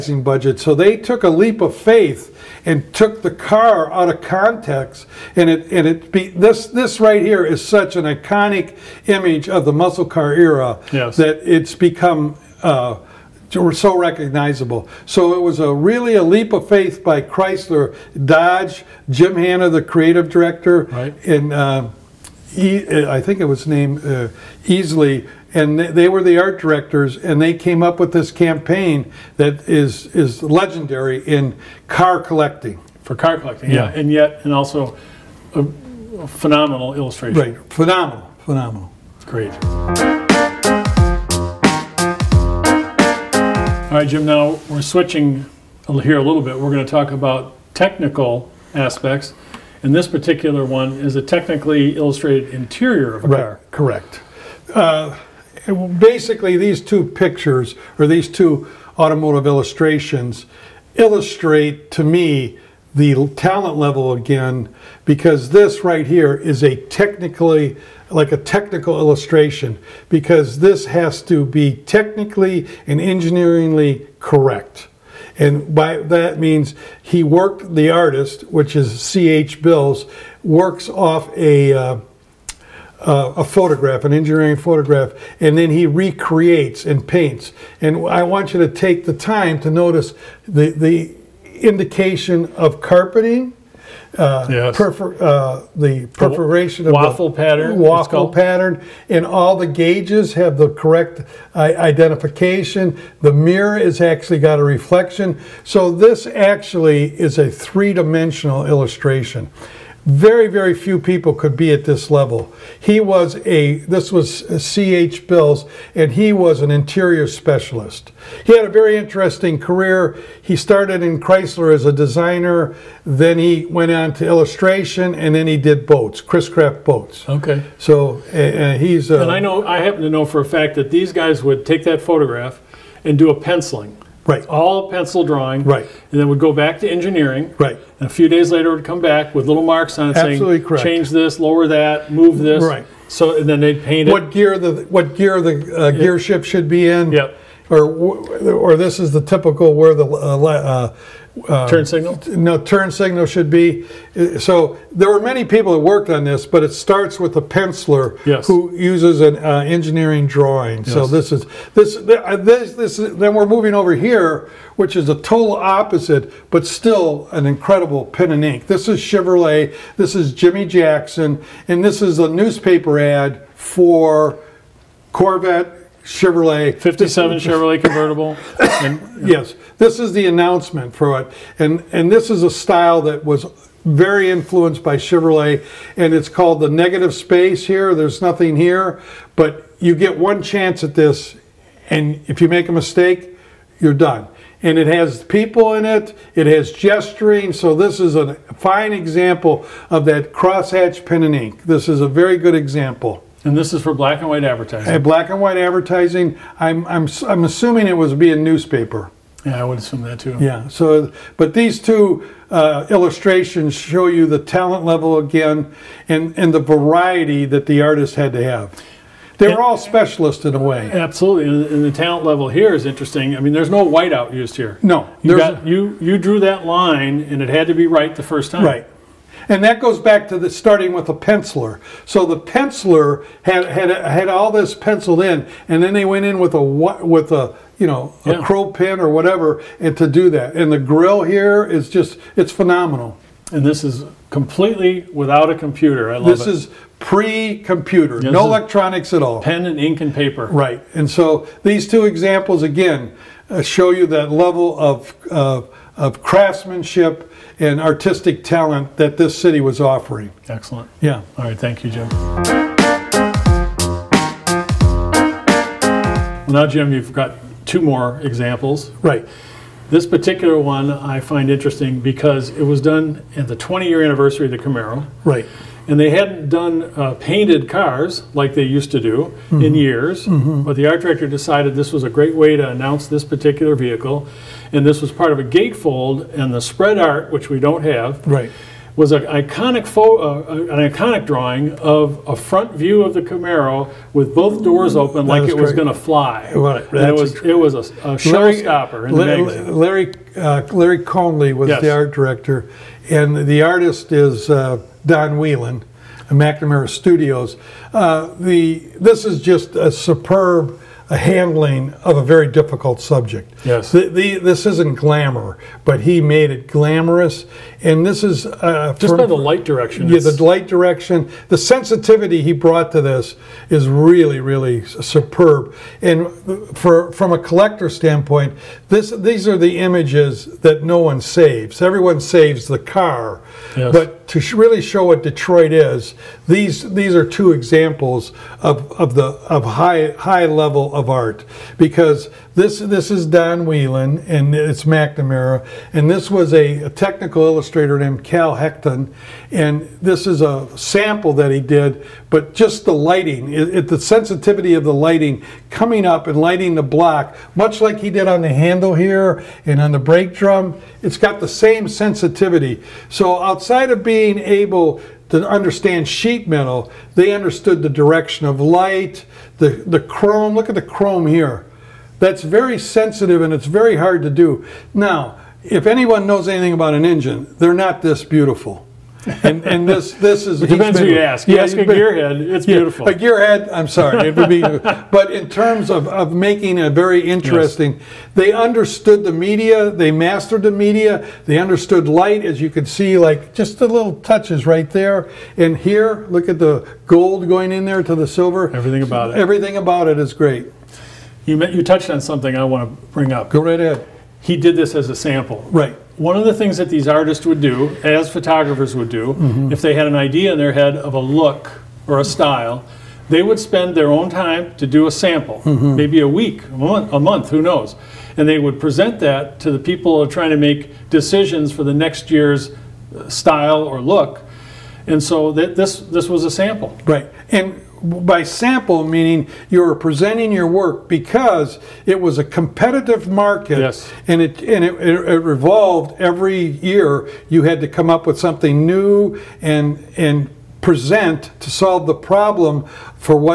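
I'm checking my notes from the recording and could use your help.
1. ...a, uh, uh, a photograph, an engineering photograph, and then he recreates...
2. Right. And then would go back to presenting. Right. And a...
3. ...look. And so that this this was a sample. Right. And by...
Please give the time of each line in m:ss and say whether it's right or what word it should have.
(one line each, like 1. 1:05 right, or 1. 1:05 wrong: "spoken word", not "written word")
1. 1:21 right
2. 2:15 wrong: "engineering", not "presenting"
3. 7:03 right.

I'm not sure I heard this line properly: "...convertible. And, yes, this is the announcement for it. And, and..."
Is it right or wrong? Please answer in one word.
right.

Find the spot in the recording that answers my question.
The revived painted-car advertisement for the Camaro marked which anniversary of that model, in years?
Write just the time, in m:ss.
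4:33.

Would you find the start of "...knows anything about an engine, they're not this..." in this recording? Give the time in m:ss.
6:16.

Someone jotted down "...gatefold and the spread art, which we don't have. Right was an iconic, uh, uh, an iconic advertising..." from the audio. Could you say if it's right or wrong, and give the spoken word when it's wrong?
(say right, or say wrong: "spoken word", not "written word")
wrong: "drawing", not "advertising".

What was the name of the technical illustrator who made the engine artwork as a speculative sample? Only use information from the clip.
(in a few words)
Cal Hecton.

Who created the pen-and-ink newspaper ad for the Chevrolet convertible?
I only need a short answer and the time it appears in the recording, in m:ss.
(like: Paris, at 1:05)
Jimmy Jackson, at 2:50.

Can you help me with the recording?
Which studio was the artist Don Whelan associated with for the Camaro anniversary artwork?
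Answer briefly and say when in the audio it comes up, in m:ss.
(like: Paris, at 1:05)
McNamara Studios, at 5:06.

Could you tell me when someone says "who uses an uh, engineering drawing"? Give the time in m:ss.
2:38.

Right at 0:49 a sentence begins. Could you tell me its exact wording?
And this particular one is a technically illustrated interior of a right, car.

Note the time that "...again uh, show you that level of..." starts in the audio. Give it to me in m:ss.
4:12.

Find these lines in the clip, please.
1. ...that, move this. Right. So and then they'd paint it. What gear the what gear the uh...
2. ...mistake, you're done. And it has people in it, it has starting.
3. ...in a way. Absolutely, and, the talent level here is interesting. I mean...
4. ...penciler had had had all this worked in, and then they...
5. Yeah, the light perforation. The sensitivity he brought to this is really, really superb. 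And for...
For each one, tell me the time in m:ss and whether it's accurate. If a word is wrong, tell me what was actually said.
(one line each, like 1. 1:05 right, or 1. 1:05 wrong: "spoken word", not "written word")
1. 2:21 right
2. 3:12 wrong: "gesturing", not "starting"
3. 3:40 right
4. 3:52 wrong: "penciled", not "worked"
5. 5:20 wrong: "direction", not "perforation".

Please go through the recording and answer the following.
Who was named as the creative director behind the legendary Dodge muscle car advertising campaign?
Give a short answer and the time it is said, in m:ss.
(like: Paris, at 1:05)
Jim Hanna, at 0:19.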